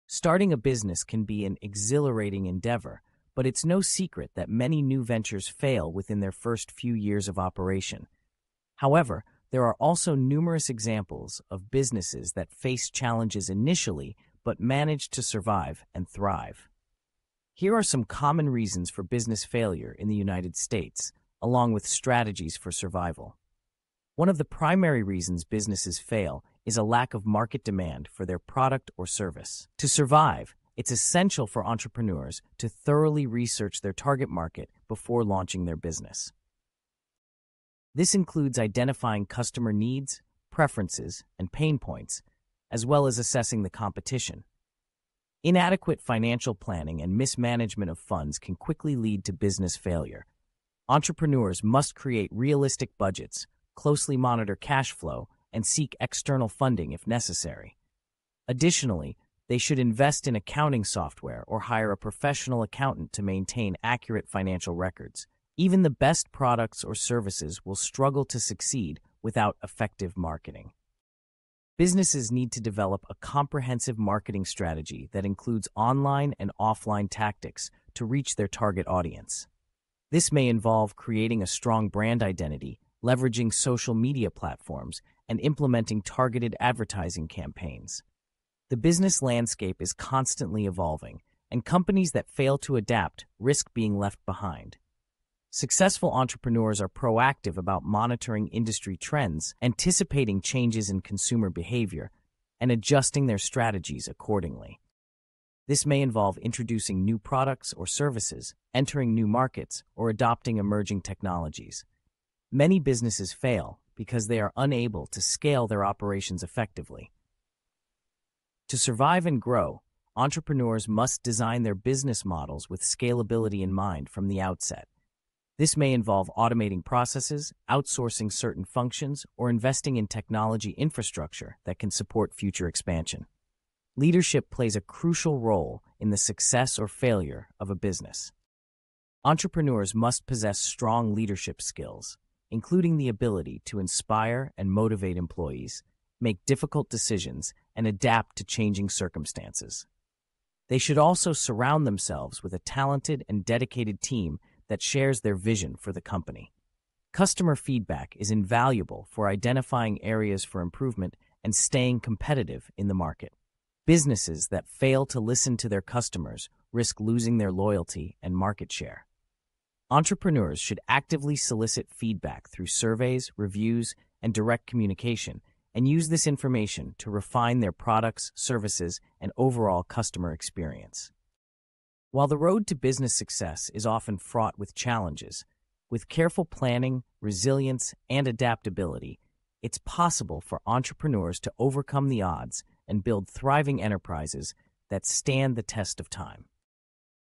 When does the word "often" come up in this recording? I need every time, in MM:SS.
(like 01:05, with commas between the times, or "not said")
03:03.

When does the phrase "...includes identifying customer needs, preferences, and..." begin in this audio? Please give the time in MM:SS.
00:38.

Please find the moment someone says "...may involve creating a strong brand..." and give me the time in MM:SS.
01:20.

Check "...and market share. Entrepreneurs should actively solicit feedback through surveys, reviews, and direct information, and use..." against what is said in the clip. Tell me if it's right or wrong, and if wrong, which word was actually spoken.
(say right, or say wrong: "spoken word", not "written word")
wrong: "communication", not "information".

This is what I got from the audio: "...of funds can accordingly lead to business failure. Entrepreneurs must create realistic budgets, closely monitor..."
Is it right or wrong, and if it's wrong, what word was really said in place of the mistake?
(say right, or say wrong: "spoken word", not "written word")
wrong: "quickly", not "accordingly".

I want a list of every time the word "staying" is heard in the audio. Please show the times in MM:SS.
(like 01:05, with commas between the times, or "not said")
02:41.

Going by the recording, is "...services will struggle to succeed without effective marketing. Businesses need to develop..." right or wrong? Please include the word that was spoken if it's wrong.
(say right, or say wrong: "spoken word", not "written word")
right.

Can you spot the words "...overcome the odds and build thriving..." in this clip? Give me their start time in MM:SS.
03:11.